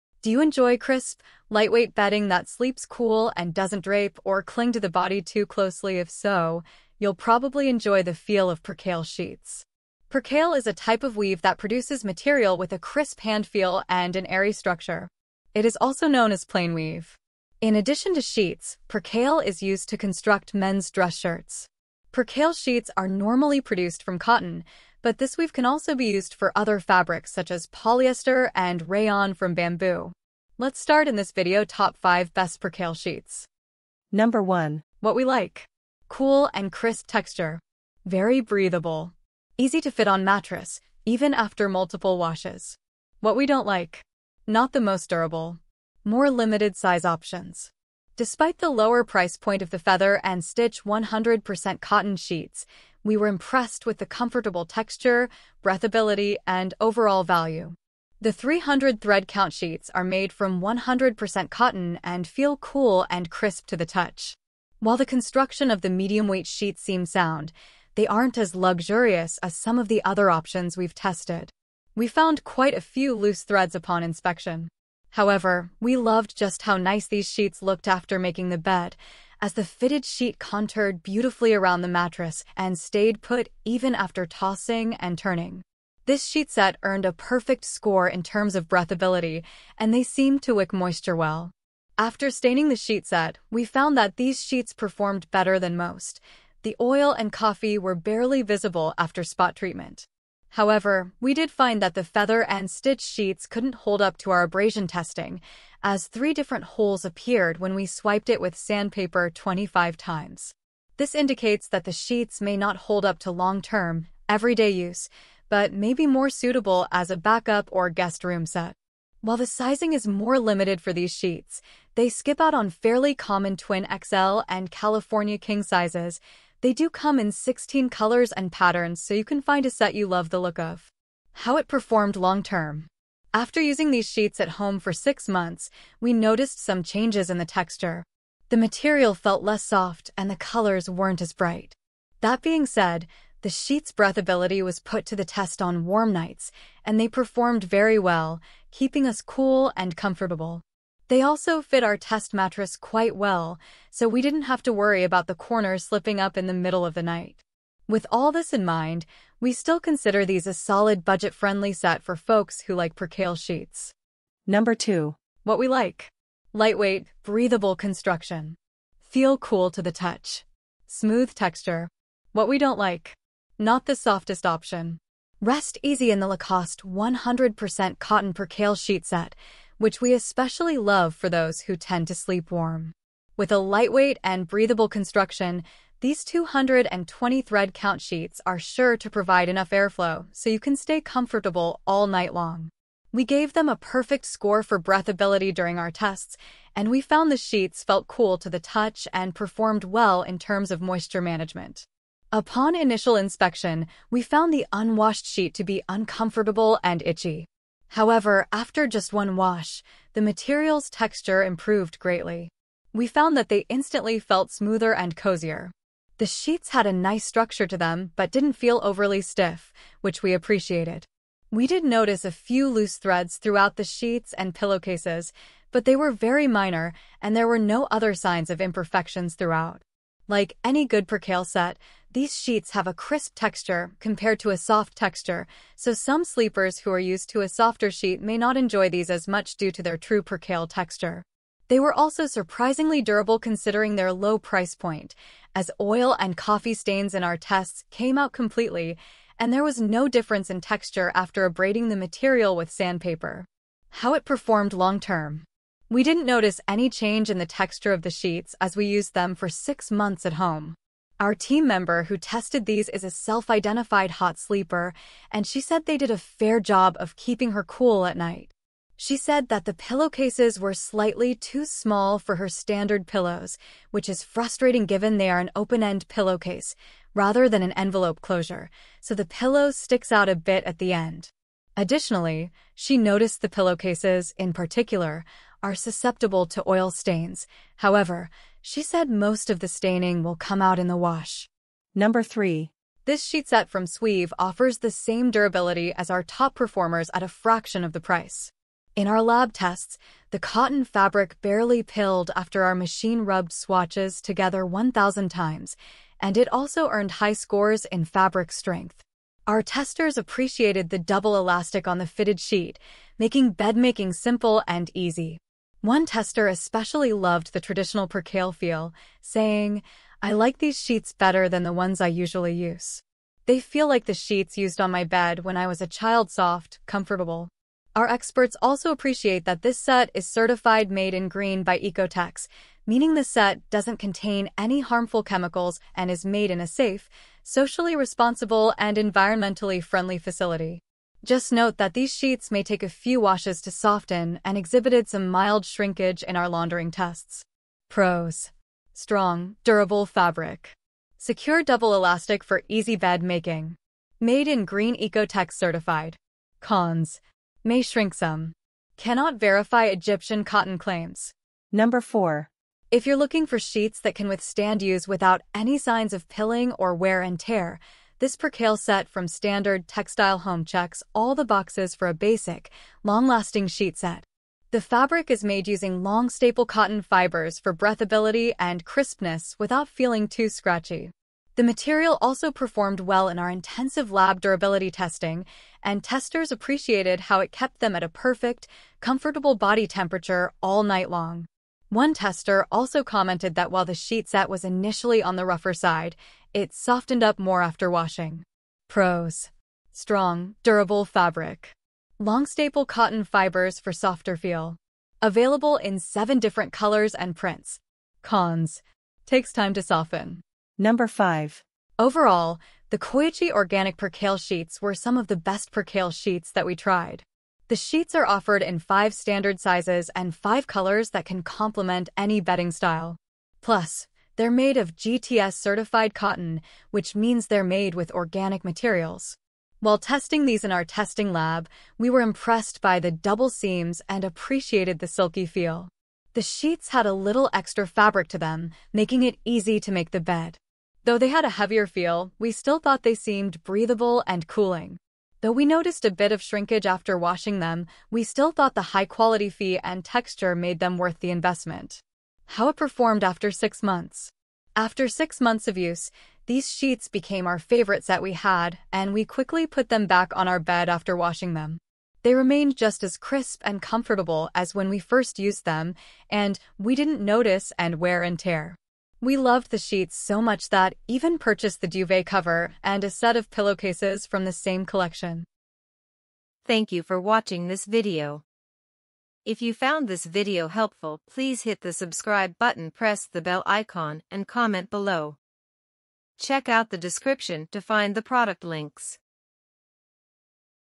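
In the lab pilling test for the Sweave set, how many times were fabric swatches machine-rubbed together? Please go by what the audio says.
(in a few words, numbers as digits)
1,000.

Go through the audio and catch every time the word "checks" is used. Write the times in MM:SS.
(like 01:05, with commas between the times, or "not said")
06:10, 08:06.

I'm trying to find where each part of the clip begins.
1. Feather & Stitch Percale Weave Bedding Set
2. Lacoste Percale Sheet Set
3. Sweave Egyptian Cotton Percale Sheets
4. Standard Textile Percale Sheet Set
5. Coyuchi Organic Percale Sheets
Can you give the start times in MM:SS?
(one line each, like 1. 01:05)
1. 00:33
2. 02:44
3. 04:51
4. 06:01
5. 06:50.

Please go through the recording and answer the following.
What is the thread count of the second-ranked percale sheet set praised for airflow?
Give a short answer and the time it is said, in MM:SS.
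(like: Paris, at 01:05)
220, at 03:06.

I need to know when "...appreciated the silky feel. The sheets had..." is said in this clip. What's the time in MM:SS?
07:14.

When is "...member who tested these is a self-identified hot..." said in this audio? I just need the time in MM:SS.
04:21.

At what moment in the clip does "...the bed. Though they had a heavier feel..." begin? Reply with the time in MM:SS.
07:20.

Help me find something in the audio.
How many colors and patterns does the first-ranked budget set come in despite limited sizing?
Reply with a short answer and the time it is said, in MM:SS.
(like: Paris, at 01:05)
16, at 02:07.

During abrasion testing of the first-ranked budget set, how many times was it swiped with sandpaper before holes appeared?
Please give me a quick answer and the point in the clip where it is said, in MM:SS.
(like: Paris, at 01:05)
25, at 01:49.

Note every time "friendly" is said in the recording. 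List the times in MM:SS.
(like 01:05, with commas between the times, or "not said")
02:41, 05:39.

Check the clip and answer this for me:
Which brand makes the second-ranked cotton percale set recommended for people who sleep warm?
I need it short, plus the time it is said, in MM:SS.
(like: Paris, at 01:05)
Lacoste, at 02:56.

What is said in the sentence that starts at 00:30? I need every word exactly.
Let's start in this video top 5 best percale sheets.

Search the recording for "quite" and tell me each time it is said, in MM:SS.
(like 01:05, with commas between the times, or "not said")
01:12, 02:32.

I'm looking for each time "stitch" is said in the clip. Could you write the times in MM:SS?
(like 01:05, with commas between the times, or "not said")
00:50, 01:42.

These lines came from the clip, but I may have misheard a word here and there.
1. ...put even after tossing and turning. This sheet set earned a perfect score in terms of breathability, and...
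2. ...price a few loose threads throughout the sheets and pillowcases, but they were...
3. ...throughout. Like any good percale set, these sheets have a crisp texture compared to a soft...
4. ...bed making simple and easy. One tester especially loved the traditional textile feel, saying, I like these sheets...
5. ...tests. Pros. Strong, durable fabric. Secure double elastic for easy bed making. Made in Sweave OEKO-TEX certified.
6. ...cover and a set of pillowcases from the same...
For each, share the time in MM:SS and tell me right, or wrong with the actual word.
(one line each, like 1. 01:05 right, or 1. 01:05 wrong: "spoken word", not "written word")
1. 01:23 right
2. 03:41 wrong: "notice", not "price"
3. 03:49 right
4. 05:13 wrong: "percale", not "textile"
5. 05:46 wrong: "Green", not "Sweave"
6. 07:52 right.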